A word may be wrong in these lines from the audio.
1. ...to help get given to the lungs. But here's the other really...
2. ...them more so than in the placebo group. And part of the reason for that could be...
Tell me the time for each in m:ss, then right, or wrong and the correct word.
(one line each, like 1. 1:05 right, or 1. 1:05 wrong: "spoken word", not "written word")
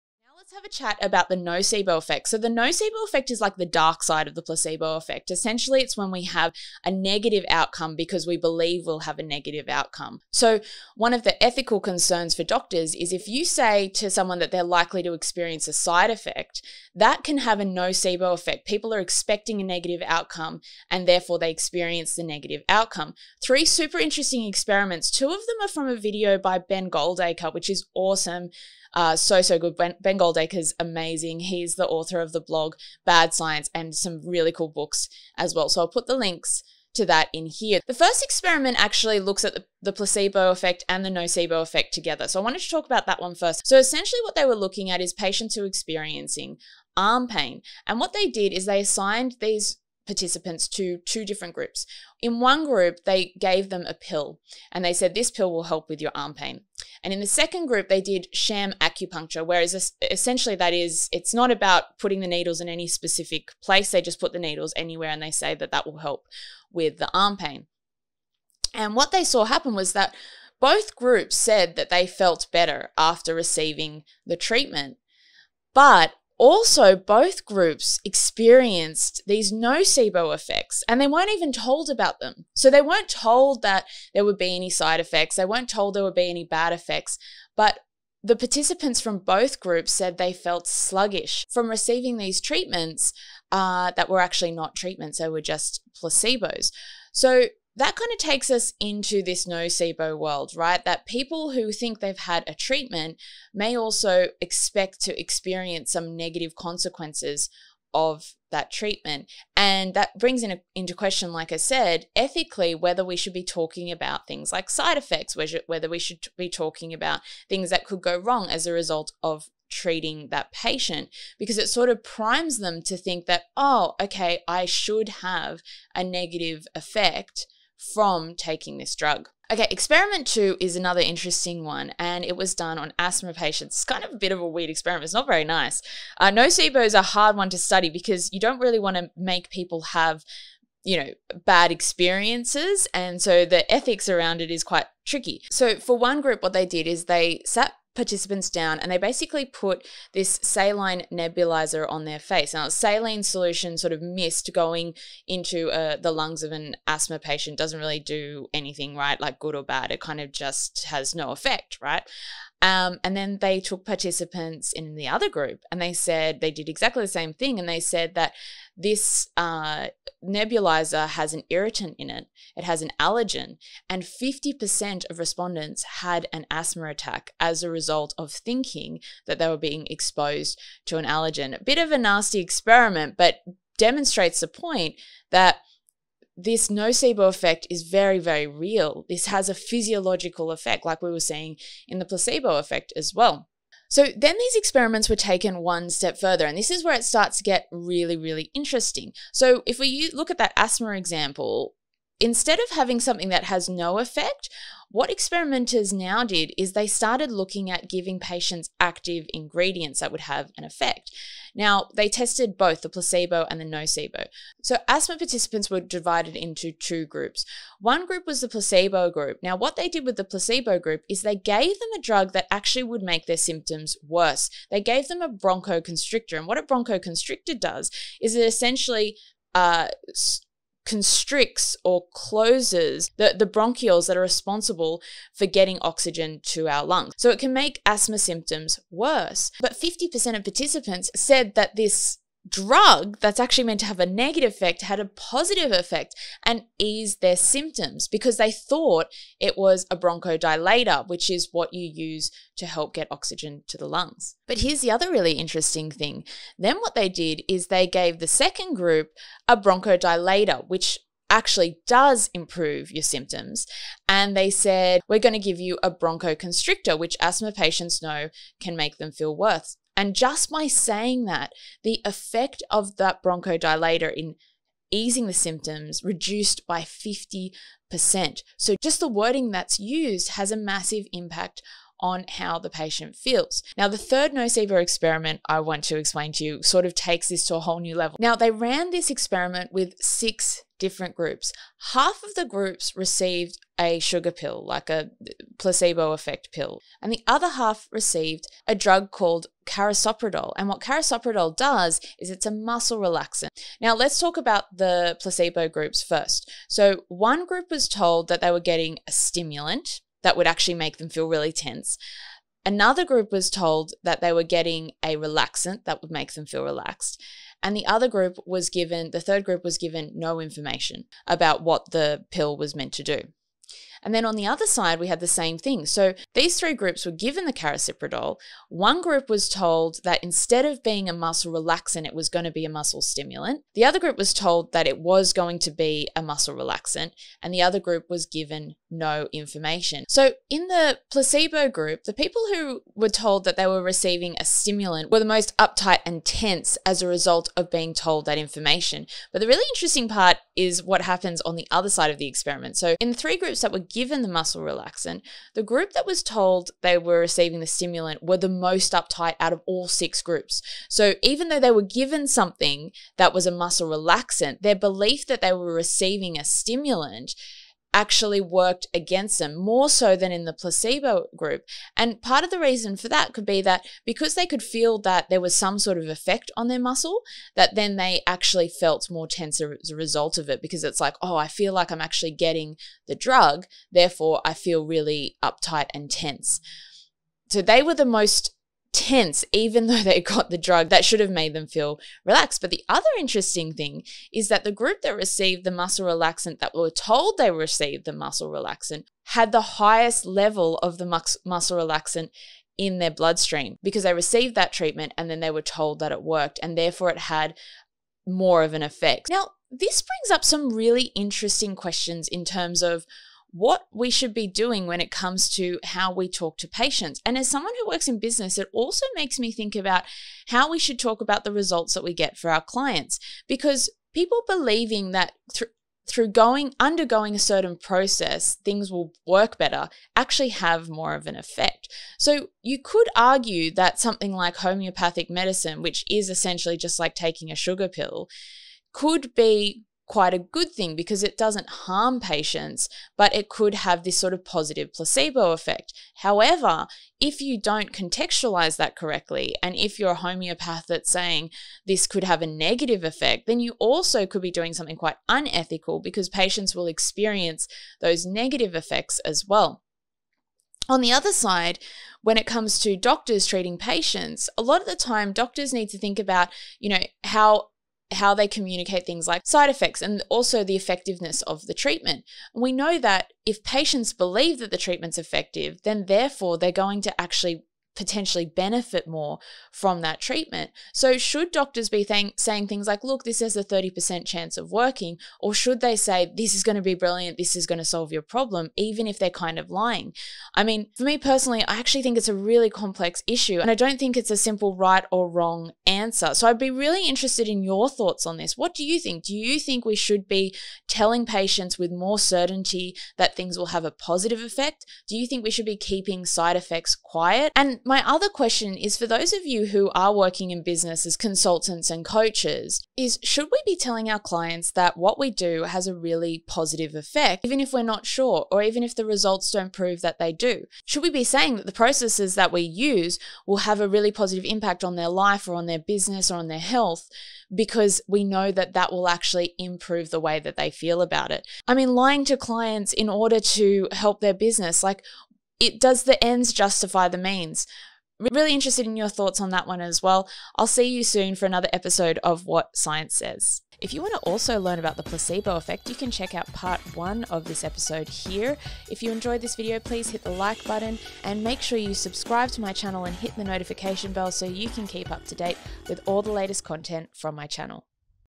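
1. 4:12 wrong: "oxygen", not "given"
2. 6:09 right.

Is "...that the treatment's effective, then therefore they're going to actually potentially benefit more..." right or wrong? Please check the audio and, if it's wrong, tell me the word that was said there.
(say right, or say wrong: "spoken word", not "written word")
right.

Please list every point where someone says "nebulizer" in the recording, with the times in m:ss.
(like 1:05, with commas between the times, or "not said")
2:31, 2:50.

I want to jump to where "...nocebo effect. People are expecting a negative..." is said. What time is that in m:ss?
0:17.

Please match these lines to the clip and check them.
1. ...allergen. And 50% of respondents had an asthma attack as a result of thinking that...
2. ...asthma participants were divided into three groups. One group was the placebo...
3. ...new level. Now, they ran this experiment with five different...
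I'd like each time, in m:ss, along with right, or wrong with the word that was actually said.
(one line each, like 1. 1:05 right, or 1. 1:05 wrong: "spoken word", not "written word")
1. 2:52 right
2. 3:34 wrong: "two", not "three"
3. 4:47 wrong: "six", not "five".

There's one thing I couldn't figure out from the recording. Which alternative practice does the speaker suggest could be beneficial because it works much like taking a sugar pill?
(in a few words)
Homeopathic medicine.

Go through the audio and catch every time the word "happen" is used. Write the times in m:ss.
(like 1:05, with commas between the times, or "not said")
1:09, 5:51.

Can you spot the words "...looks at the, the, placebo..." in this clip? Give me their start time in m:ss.
0:39.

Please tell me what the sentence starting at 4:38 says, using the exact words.
So just the wording that's used has a massive impact on how the patient feels.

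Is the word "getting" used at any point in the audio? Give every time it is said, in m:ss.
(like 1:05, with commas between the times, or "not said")
3:55, 5:08, 5:14, 6:22.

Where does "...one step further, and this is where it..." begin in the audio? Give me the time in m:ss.
3:15.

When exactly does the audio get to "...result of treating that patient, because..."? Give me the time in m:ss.
1:58.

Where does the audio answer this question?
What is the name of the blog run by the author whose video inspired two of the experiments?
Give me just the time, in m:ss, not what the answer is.
0:33.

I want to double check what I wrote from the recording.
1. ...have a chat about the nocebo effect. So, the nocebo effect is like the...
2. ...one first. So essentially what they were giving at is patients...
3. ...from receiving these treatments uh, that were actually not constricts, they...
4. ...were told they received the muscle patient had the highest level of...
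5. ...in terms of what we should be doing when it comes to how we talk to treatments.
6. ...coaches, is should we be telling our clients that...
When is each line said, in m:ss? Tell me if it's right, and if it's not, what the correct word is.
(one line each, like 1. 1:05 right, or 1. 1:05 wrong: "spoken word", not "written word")
1. 0:00 right
2. 0:43 wrong: "looking", not "giving"
3. 1:31 wrong: "treatments", not "constricts"
4. 6:36 wrong: "relaxant", not "patient"
5. 6:52 wrong: "patients", not "treatments"
6. 8:32 right.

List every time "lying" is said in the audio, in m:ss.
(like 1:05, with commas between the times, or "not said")
8:09, 8:51.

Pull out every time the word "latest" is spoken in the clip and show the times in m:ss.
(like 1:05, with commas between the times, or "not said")
9:16.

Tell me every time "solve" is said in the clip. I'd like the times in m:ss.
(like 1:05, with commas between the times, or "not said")
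8:07.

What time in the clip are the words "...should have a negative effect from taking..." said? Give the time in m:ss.
2:04.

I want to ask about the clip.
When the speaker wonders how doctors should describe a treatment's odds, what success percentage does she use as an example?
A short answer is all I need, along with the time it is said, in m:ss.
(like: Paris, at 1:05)
30%, at 8:03.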